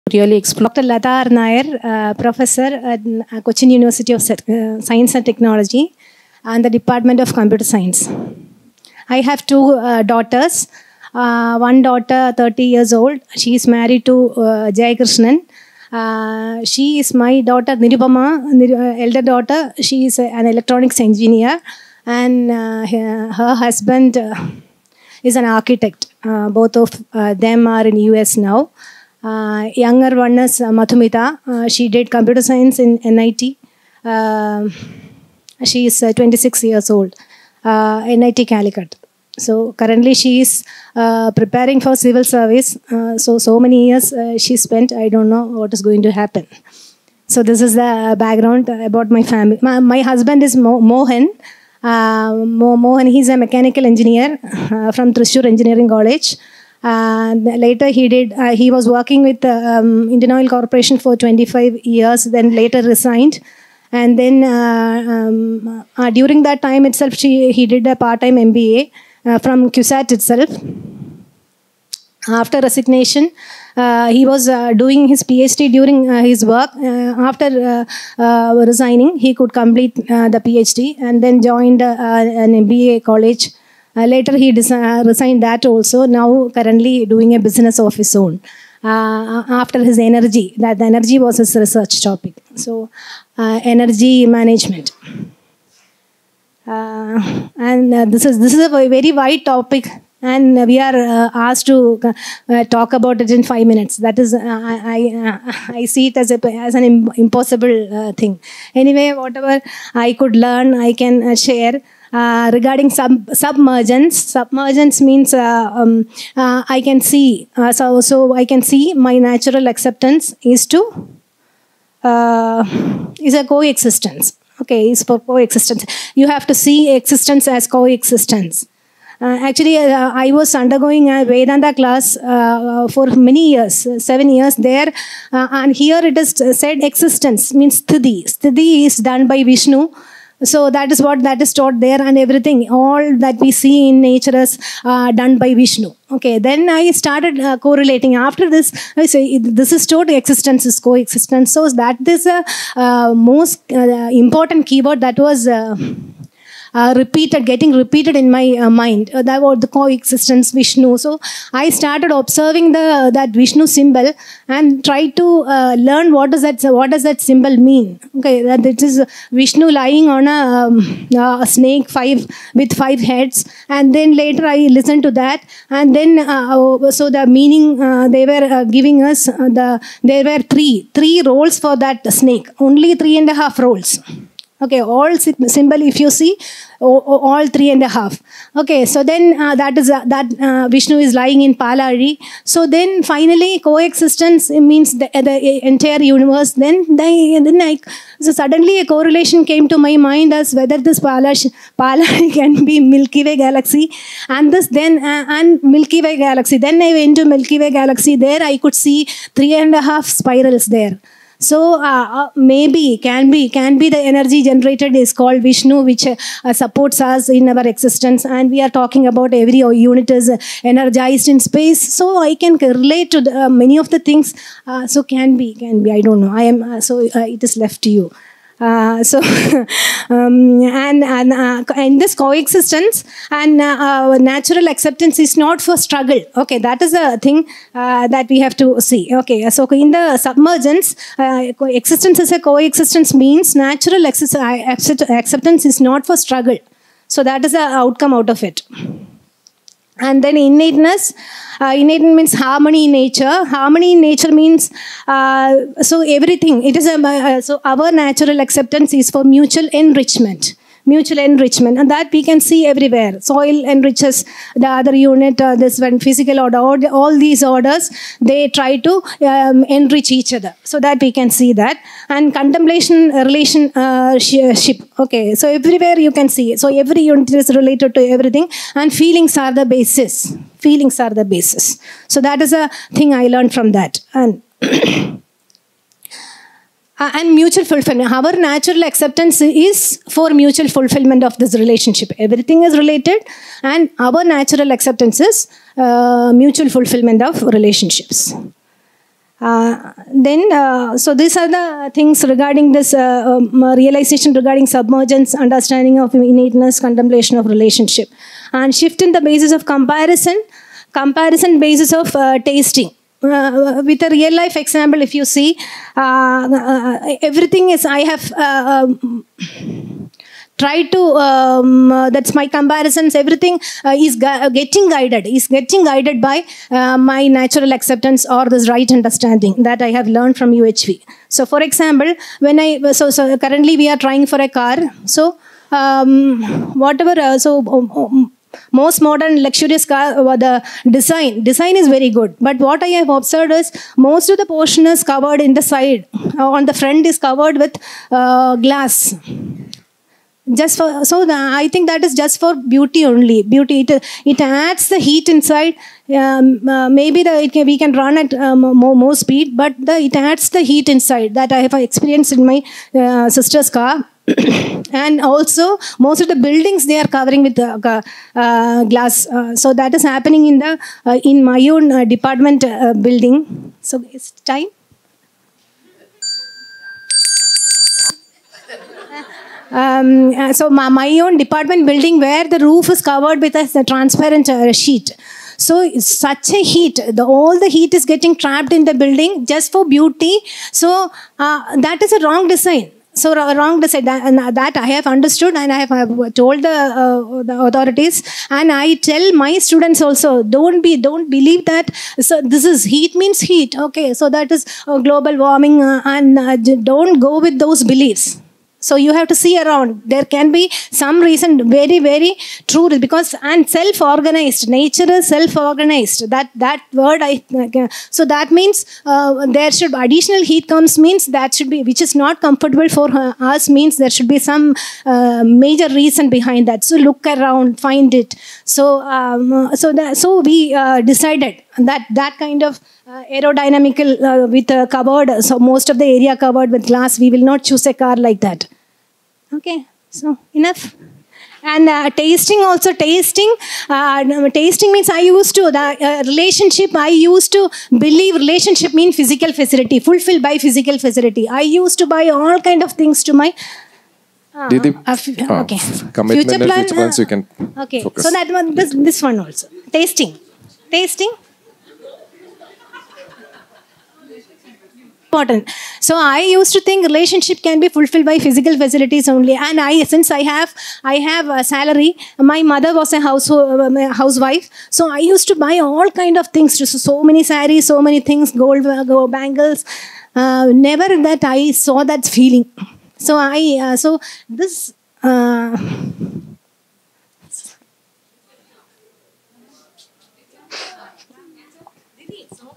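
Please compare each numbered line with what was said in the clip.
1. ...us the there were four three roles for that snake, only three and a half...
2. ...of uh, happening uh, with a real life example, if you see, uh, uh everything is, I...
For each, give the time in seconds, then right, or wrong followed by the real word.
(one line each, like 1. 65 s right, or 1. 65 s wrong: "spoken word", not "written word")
1. 179 s wrong: "three", not "four"
2. 311 s wrong: "tasting", not "happening".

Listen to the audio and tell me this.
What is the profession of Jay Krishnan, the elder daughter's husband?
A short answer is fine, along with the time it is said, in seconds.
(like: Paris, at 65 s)
Architect, at 25 s.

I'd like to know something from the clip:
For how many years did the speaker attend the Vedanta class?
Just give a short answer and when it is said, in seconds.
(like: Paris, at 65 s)
7 years, at 134 s.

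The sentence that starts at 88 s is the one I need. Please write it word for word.
Uh, uh after his energy, that the energy was his research topic.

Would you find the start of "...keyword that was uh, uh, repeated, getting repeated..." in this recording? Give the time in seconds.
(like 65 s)
154 s.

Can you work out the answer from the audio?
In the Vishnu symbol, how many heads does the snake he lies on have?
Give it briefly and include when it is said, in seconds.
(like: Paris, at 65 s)
5, at 172 s.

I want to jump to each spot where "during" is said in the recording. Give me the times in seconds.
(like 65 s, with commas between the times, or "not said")
66 s, 75 s.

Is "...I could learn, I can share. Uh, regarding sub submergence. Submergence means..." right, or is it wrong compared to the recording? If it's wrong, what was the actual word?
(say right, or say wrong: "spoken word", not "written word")
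right.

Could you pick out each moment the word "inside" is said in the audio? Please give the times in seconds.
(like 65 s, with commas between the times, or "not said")
355 s, 360 s.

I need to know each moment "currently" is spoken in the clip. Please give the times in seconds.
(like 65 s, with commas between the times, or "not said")
39 s, 86 s, 333 s.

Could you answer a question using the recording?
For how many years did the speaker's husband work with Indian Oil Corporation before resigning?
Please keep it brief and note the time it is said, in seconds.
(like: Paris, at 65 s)
25 years, at 61 s.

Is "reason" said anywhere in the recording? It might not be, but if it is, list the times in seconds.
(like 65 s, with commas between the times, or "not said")
411 s, 425 s.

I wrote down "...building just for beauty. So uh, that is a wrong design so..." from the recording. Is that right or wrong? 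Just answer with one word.
right.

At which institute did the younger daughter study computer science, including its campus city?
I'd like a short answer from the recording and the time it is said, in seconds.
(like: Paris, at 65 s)
NIT Calicut, at 37 s.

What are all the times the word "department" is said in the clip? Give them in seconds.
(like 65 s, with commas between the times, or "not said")
6 s, 372 s, 381 s.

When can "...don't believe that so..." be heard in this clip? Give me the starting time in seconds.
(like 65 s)
400 s.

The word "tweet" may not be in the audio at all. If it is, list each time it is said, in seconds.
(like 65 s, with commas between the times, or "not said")
not said.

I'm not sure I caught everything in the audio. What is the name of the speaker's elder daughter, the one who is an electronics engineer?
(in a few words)
Nirupama.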